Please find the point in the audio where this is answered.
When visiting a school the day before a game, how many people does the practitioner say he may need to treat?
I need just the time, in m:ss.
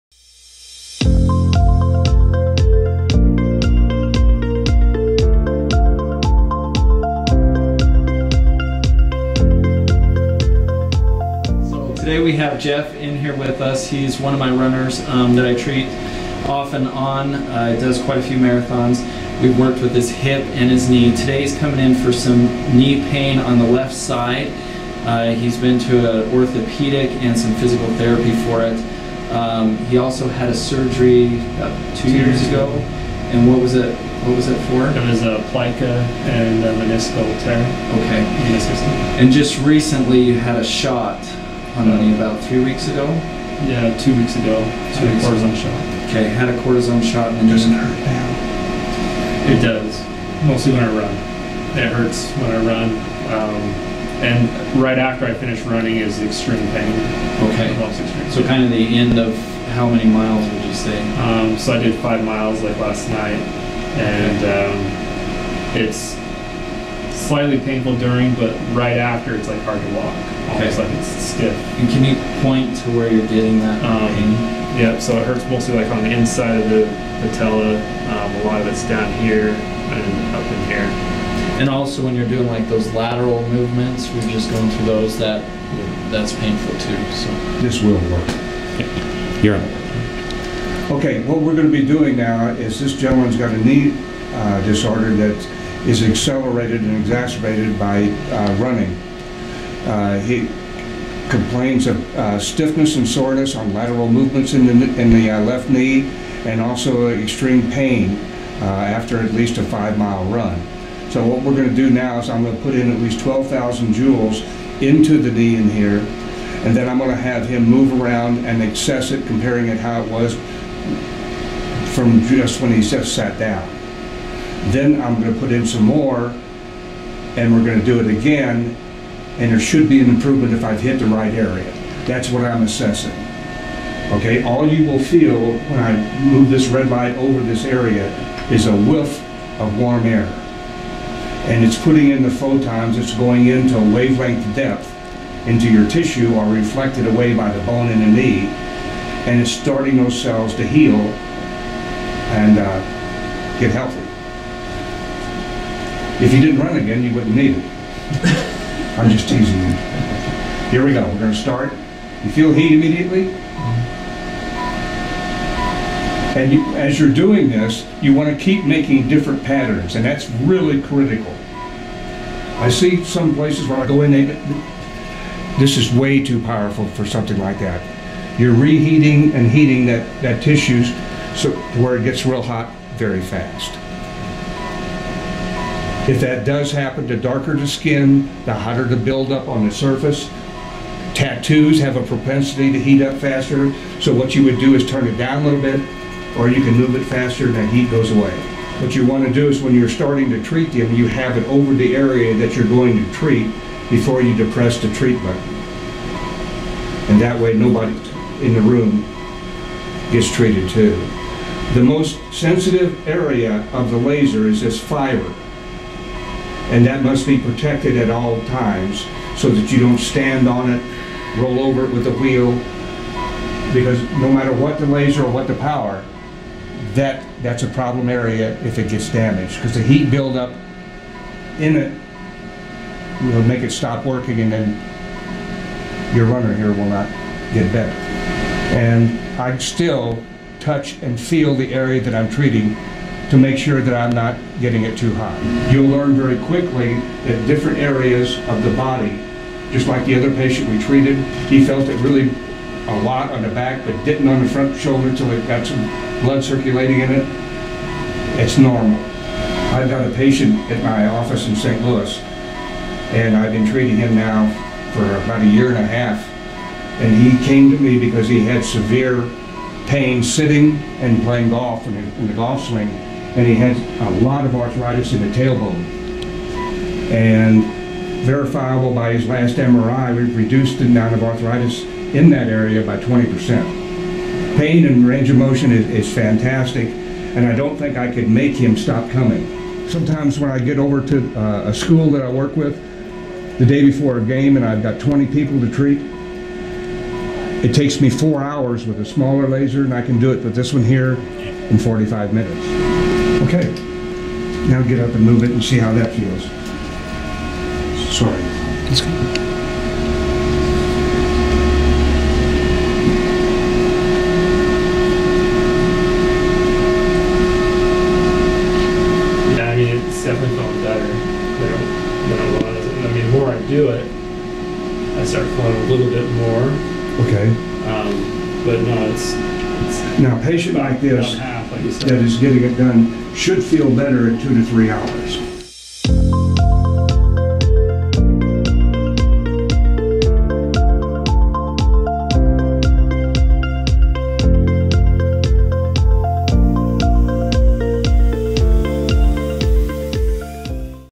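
4:54.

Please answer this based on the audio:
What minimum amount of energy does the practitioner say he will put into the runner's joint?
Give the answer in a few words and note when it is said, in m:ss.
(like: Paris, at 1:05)
12,000 joules, at 1:53.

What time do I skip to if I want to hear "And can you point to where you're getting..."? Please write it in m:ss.
1:11.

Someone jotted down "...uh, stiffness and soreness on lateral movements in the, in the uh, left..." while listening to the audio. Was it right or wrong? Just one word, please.
right.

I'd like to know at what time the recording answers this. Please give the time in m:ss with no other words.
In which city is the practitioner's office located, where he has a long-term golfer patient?
4:21.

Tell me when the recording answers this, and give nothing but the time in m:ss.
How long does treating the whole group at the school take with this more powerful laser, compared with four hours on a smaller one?
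5:01.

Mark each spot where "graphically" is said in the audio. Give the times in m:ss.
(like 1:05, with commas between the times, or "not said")
not said.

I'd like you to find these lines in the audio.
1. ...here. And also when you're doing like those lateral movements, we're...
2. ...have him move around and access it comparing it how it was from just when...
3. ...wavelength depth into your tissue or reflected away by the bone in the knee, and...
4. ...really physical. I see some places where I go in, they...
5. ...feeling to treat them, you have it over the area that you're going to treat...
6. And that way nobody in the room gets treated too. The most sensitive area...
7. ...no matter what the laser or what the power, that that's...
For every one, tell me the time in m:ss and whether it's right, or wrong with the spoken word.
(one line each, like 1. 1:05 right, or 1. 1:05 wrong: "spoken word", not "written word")
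1. 1:20 right
2. 1:57 right
3. 2:23 right
4. 2:50 wrong: "critical", not "physical"
5. 3:19 wrong: "starting", not "feeling"
6. 3:27 right
7. 3:44 right.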